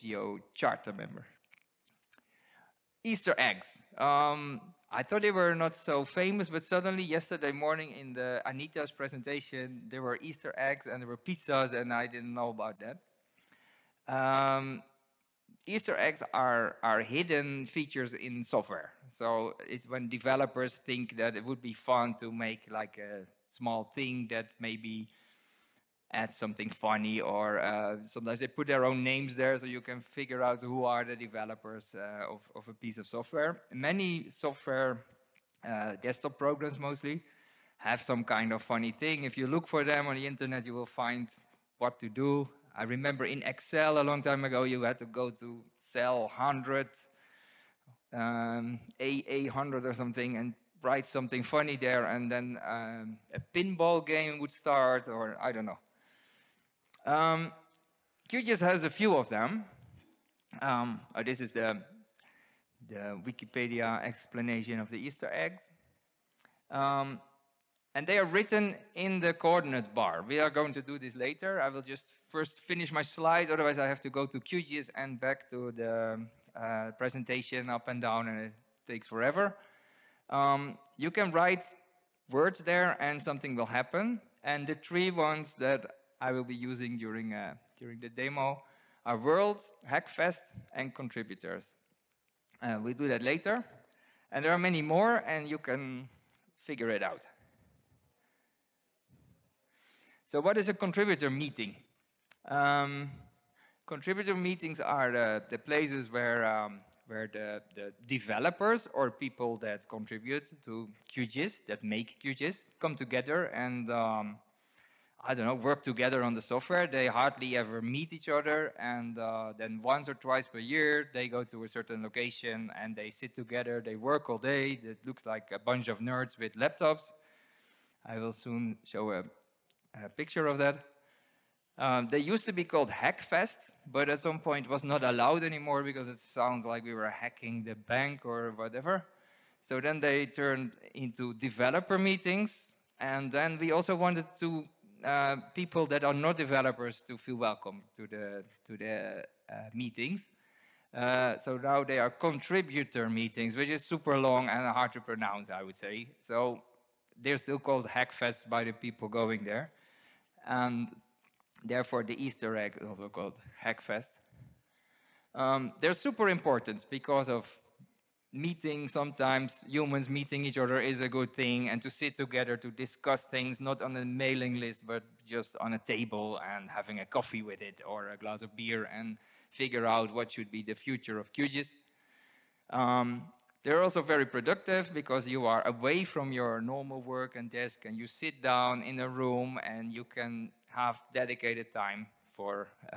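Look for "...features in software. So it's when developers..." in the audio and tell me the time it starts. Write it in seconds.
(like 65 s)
17 s.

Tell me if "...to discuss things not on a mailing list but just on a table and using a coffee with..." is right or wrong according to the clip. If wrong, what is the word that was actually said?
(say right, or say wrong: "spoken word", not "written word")
wrong: "having", not "using".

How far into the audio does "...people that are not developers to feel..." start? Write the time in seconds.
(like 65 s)
145 s.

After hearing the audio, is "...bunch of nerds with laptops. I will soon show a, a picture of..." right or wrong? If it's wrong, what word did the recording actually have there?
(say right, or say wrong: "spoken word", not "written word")
right.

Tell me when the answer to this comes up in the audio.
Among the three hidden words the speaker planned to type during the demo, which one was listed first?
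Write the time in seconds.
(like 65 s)
89 s.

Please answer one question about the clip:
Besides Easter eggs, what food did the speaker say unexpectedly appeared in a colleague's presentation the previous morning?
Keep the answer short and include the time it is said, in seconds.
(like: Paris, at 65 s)
Pizzas, at 11 s.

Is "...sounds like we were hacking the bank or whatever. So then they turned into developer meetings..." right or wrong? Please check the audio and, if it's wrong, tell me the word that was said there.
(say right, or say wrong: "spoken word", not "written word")
right.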